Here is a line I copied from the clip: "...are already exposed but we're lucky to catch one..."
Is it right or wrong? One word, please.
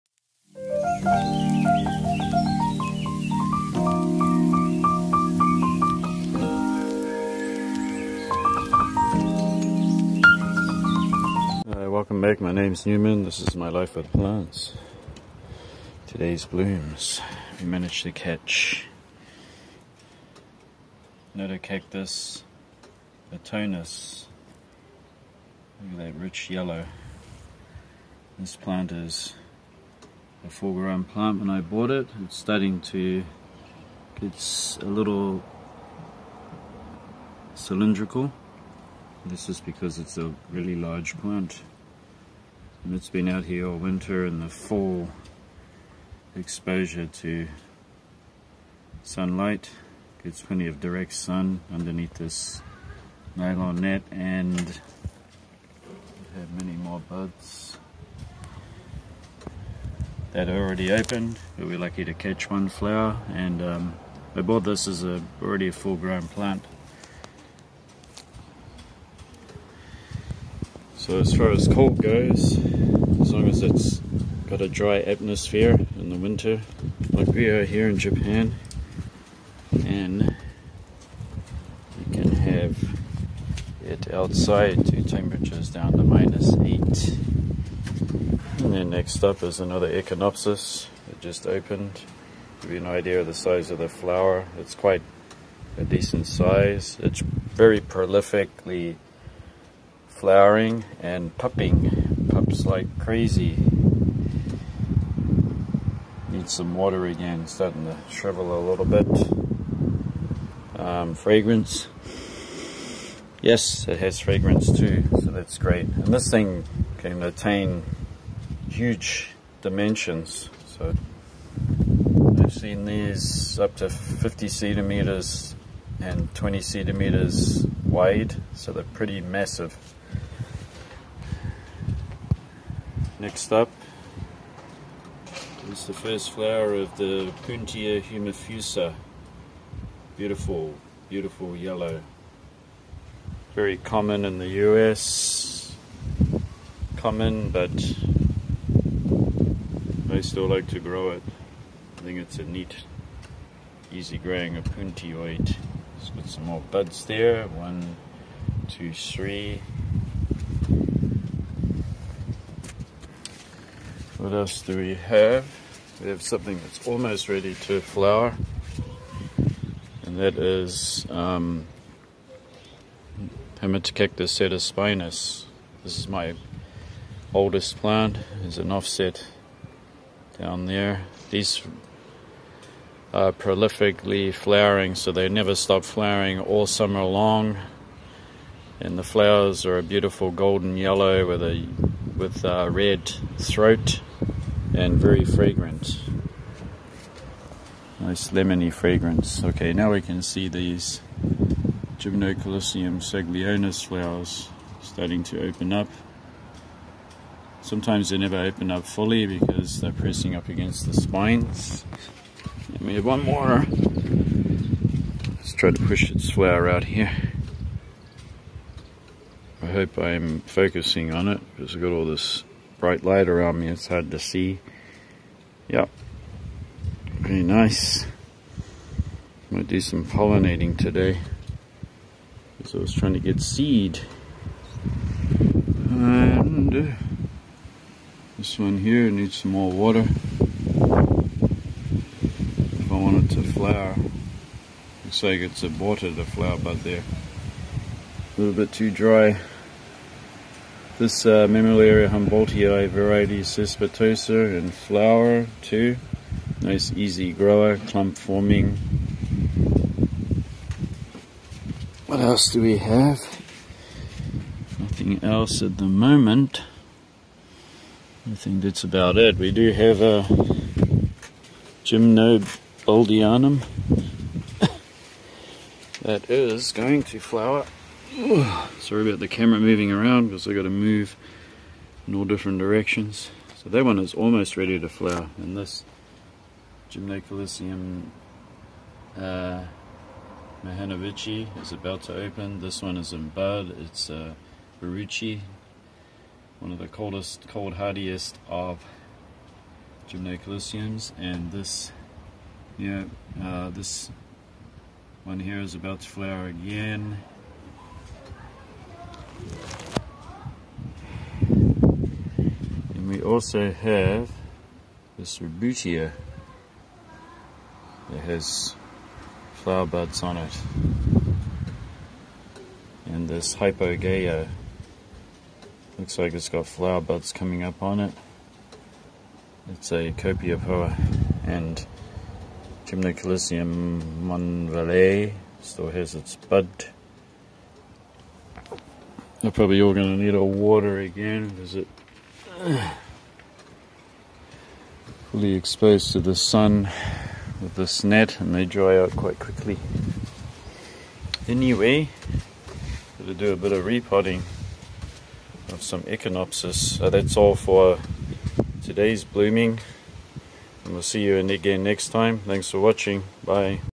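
wrong.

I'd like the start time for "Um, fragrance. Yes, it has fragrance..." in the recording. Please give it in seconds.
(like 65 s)
110 s.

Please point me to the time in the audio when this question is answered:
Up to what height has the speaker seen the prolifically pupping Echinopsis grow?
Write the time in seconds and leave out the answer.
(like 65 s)
123 s.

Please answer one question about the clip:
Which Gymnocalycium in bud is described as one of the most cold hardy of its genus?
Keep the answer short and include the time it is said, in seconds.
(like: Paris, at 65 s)
Bruchii, at 294 s.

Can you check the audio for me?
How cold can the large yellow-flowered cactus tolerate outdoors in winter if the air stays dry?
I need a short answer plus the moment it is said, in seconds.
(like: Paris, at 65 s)
-8, at 86 s.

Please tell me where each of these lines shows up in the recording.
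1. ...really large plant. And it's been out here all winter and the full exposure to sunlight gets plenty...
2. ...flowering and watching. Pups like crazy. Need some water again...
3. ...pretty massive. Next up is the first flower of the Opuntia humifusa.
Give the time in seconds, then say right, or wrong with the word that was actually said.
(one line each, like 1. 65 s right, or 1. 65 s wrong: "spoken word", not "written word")
1. 40 s right
2. 100 s wrong: "pupping", not "watching"
3. 128 s right.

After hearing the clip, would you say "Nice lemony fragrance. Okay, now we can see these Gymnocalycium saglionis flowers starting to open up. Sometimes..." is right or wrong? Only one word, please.
right.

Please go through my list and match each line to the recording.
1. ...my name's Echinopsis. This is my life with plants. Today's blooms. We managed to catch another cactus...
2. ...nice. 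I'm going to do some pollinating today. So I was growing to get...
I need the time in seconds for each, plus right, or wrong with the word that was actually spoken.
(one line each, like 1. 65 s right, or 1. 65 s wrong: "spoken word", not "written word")
1. 12 s wrong: "Newman", not "Echinopsis"
2. 227 s wrong: "trying", not "growing".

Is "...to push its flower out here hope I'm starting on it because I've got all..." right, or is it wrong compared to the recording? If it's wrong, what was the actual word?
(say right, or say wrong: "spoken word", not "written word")
wrong: "focusing", not "starting".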